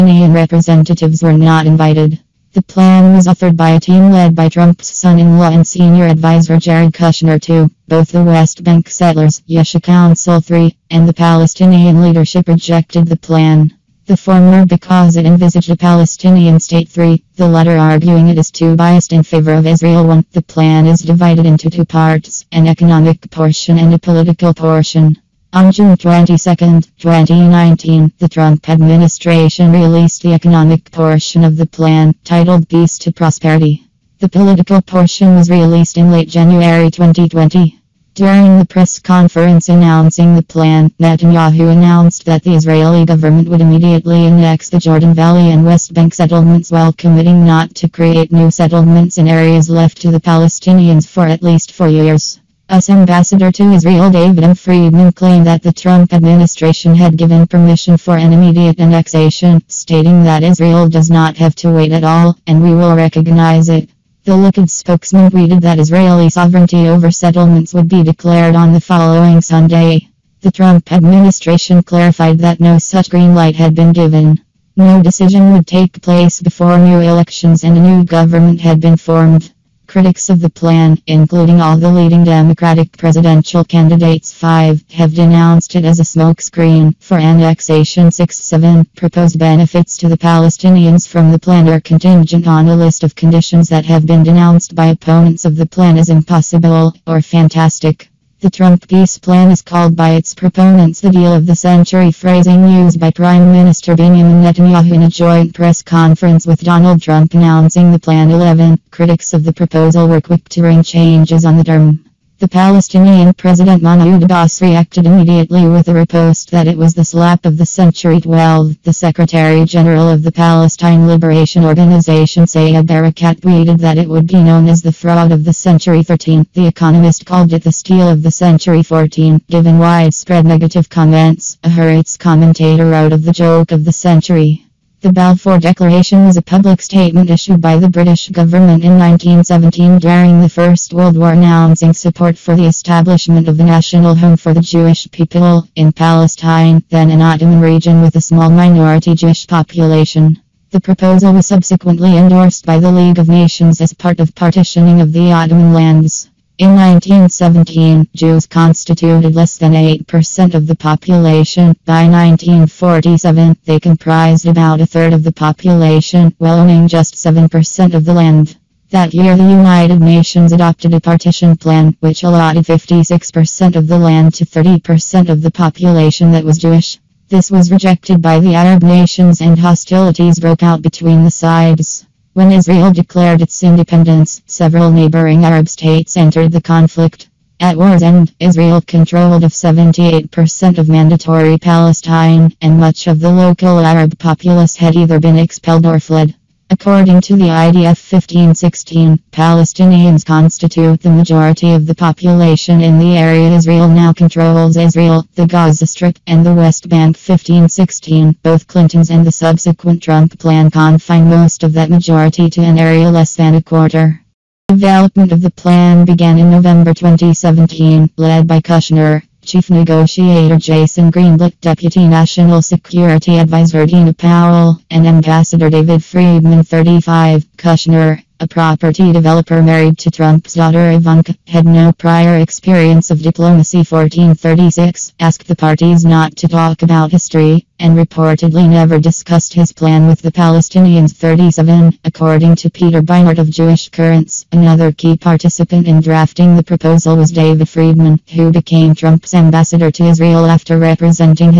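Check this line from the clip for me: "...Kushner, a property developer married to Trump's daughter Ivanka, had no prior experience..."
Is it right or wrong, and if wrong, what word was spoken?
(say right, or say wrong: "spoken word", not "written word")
right.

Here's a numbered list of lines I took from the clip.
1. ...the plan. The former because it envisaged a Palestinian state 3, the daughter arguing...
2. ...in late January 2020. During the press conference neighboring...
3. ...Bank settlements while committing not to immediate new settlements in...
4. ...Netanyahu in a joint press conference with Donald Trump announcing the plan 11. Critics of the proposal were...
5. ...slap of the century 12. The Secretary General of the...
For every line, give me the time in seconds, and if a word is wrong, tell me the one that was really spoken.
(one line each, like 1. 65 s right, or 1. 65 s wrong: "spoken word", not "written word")
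1. 13 s wrong: "latter", not "daughter"
2. 35 s wrong: "announcing", not "neighboring"
3. 45 s wrong: "create", not "immediate"
4. 104 s right
5. 117 s right.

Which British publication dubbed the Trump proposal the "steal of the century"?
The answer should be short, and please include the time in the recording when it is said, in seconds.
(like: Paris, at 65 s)
The Economist, at 126 s.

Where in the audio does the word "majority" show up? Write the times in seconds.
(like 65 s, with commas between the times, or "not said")
201 s, 211 s.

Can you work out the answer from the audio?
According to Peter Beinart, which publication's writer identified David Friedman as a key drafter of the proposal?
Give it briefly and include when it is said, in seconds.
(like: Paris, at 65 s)
Jewish Currents, at 243 s.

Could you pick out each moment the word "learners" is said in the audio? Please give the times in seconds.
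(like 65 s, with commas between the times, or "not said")
not said.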